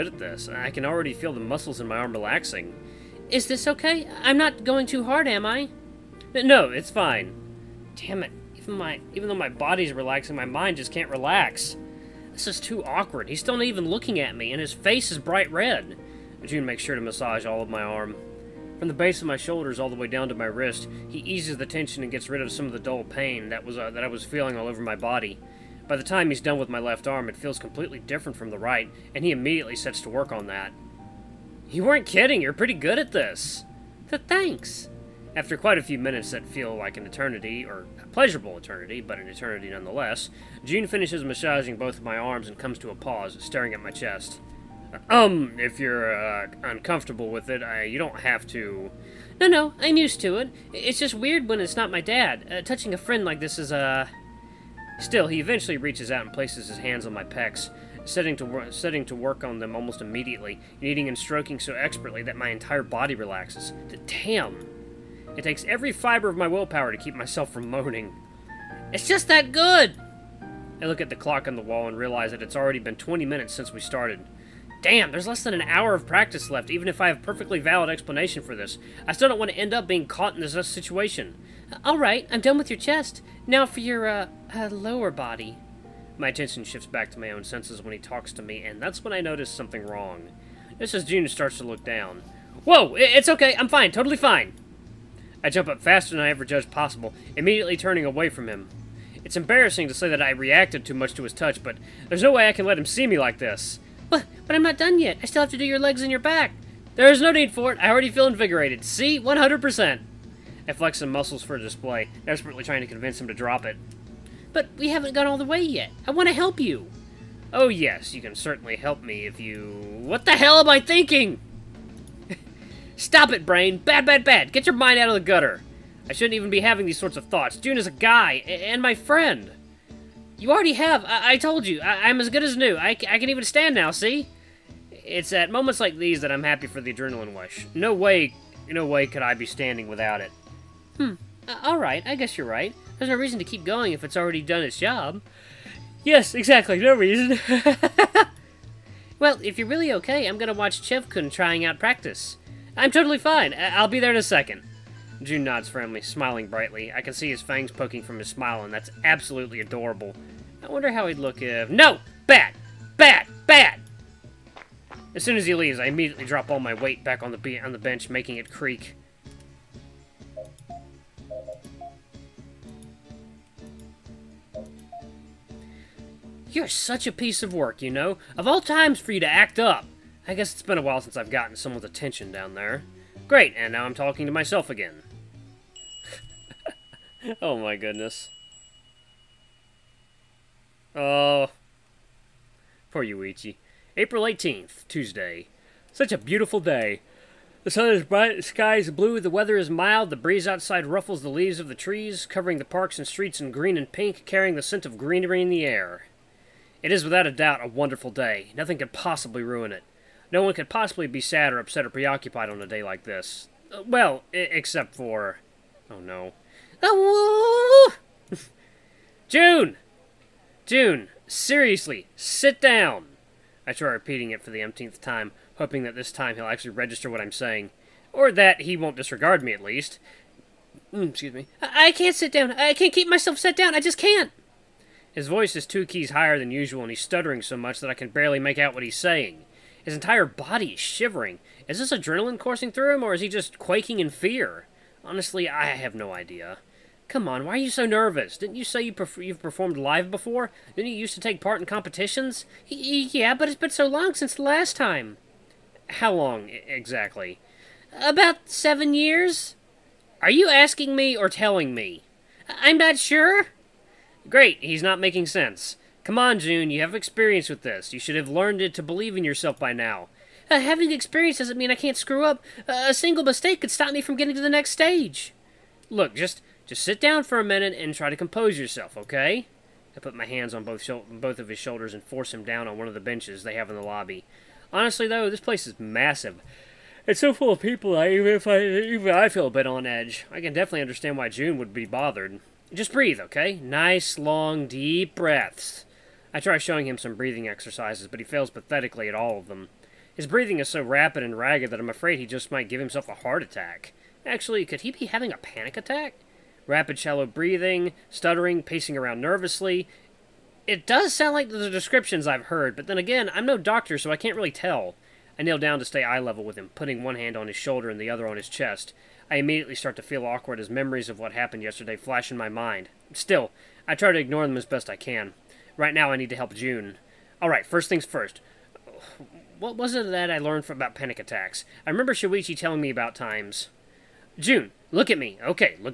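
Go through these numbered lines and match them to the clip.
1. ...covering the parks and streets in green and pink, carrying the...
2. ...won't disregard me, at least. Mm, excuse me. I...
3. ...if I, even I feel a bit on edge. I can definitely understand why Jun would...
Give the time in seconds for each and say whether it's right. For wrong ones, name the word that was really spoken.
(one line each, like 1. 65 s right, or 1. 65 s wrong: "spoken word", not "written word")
1. 202 s right
2. 228 s right
3. 288 s right.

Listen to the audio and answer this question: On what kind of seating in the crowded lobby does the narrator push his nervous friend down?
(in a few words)
benches.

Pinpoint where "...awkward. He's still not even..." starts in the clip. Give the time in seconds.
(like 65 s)
12 s.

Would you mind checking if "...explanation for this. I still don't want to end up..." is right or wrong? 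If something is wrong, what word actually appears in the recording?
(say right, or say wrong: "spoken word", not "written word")
right.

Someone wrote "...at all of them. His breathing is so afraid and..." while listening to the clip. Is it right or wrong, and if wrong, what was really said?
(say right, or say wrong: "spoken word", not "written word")
wrong: "rapid", not "afraid".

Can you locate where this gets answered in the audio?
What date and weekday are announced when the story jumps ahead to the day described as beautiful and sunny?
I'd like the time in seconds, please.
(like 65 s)
193 s.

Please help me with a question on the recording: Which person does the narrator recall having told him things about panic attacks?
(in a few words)
Shuichi.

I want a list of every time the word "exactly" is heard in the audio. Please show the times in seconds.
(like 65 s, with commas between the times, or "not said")
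146 s, 256 s.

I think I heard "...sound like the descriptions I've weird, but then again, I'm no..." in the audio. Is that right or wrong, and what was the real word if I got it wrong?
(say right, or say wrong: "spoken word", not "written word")
wrong: "heard", not "weird".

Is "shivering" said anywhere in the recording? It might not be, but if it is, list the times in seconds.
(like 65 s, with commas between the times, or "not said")
240 s.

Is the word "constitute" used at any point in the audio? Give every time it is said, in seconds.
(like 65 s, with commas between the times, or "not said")
not said.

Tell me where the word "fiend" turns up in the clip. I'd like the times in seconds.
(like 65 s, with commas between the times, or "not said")
not said.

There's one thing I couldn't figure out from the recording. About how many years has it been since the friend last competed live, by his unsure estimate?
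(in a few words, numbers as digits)
7.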